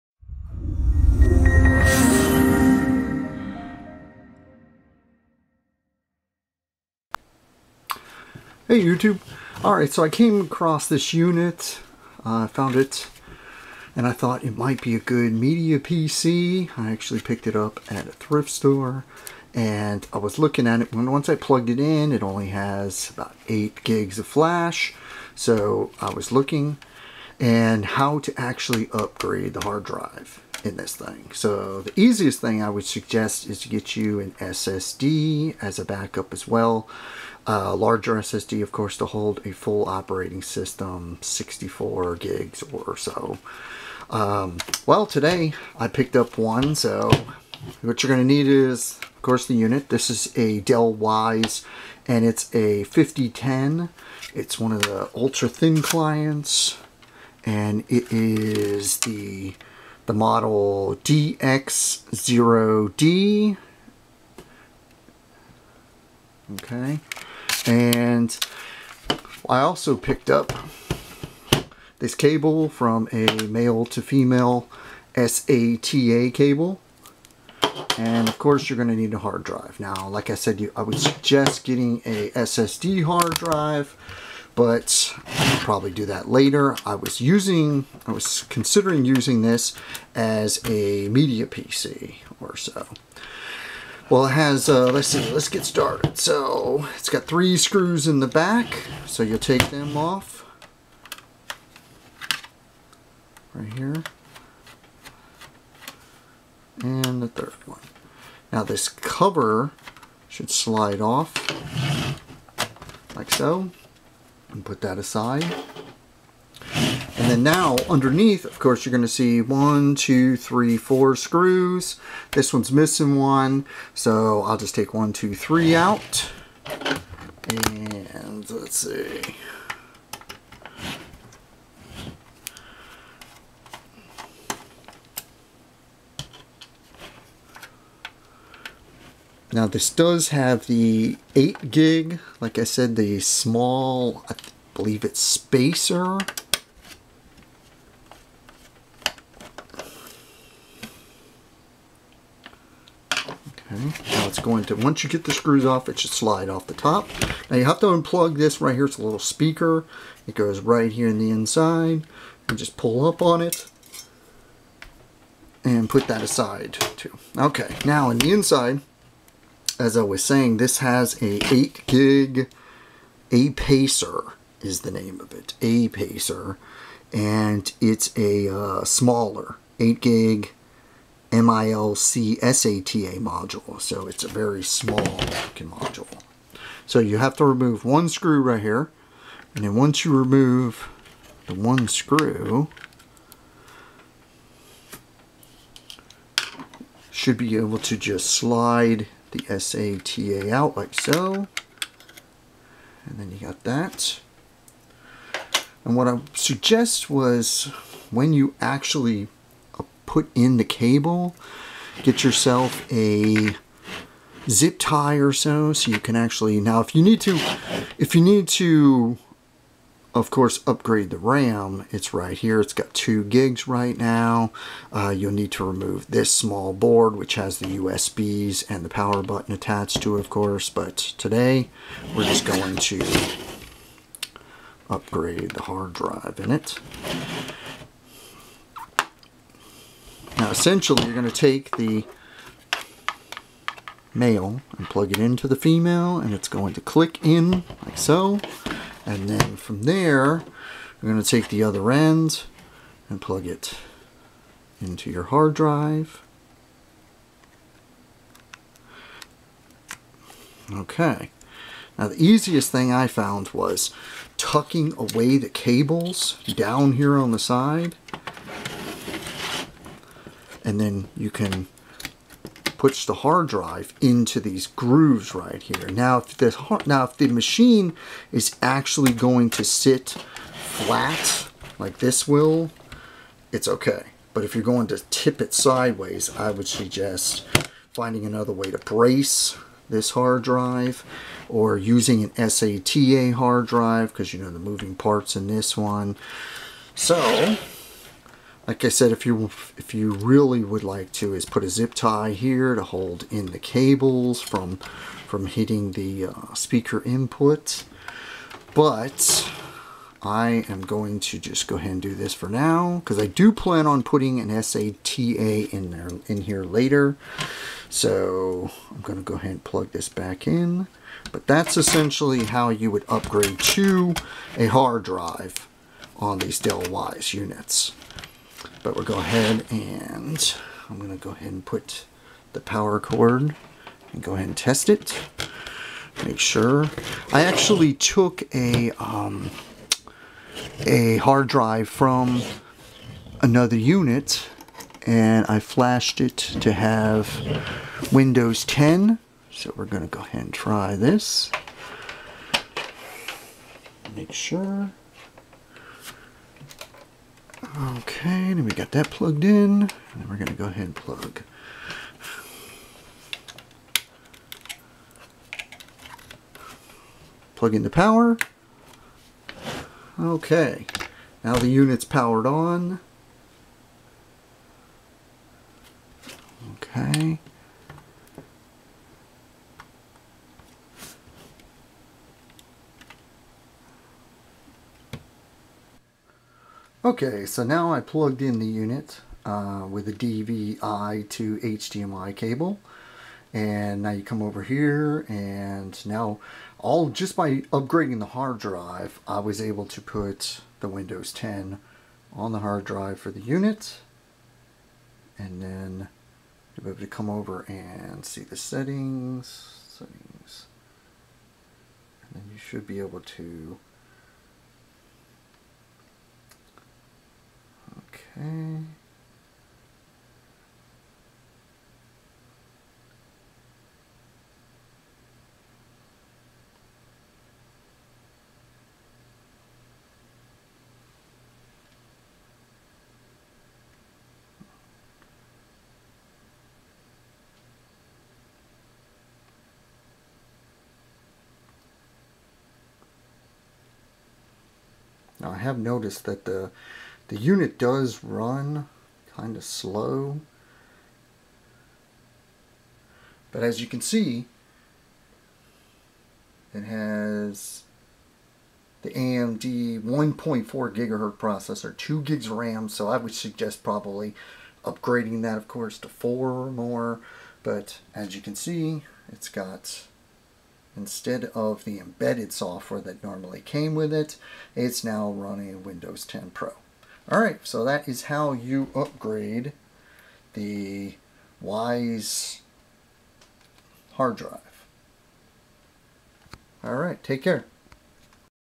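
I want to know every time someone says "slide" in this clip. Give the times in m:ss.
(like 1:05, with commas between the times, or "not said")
1:50, 2:36, 3:18.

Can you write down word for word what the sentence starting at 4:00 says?
Now essentially you're going to take the male and plug it into the female and it's going to click in like so.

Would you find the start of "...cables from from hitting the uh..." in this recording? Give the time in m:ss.
5:03.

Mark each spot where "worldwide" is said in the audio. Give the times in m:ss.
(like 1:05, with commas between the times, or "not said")
not said.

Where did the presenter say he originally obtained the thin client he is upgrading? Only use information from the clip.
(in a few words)
thrift store.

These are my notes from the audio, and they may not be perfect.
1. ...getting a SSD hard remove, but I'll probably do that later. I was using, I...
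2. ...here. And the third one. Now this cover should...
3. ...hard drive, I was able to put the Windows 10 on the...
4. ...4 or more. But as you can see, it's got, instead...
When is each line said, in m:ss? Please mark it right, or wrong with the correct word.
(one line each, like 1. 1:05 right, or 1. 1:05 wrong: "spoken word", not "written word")
1. 1:21 wrong: "drive", not "remove"
2. 1:43 right
3. 6:38 right
4. 7:46 right.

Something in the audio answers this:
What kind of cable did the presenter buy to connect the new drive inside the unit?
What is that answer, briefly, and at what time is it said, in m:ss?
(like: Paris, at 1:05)
male to female SATA cable, at 1:13.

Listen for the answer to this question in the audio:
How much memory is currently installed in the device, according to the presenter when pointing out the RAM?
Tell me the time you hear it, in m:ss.
3:42.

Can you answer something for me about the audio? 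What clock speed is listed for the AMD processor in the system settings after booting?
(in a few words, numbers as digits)
1.4 gigahertz.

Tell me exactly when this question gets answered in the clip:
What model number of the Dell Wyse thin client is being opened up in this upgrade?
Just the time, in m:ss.
0:52.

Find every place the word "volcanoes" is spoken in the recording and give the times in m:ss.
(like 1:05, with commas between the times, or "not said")
not said.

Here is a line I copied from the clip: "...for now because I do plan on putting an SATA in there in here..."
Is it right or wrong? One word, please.
right.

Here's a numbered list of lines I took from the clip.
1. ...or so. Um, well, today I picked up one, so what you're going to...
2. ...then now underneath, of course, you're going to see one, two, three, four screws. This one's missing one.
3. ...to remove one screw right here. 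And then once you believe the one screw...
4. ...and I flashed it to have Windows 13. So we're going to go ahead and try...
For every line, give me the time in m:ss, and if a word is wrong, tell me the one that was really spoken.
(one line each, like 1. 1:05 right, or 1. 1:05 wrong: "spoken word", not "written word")
1. 0:42 right
2. 1:57 right
3. 3:07 wrong: "remove", not "believe"
4. 5:45 wrong: "10", not "13".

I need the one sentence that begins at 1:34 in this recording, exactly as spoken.
Well, it has, uh, let's see, let's get started.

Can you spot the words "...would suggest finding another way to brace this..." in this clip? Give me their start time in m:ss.
4:46.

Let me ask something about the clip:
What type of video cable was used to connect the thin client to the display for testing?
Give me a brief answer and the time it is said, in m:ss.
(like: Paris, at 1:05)
DVI to HDMI, at 6:30.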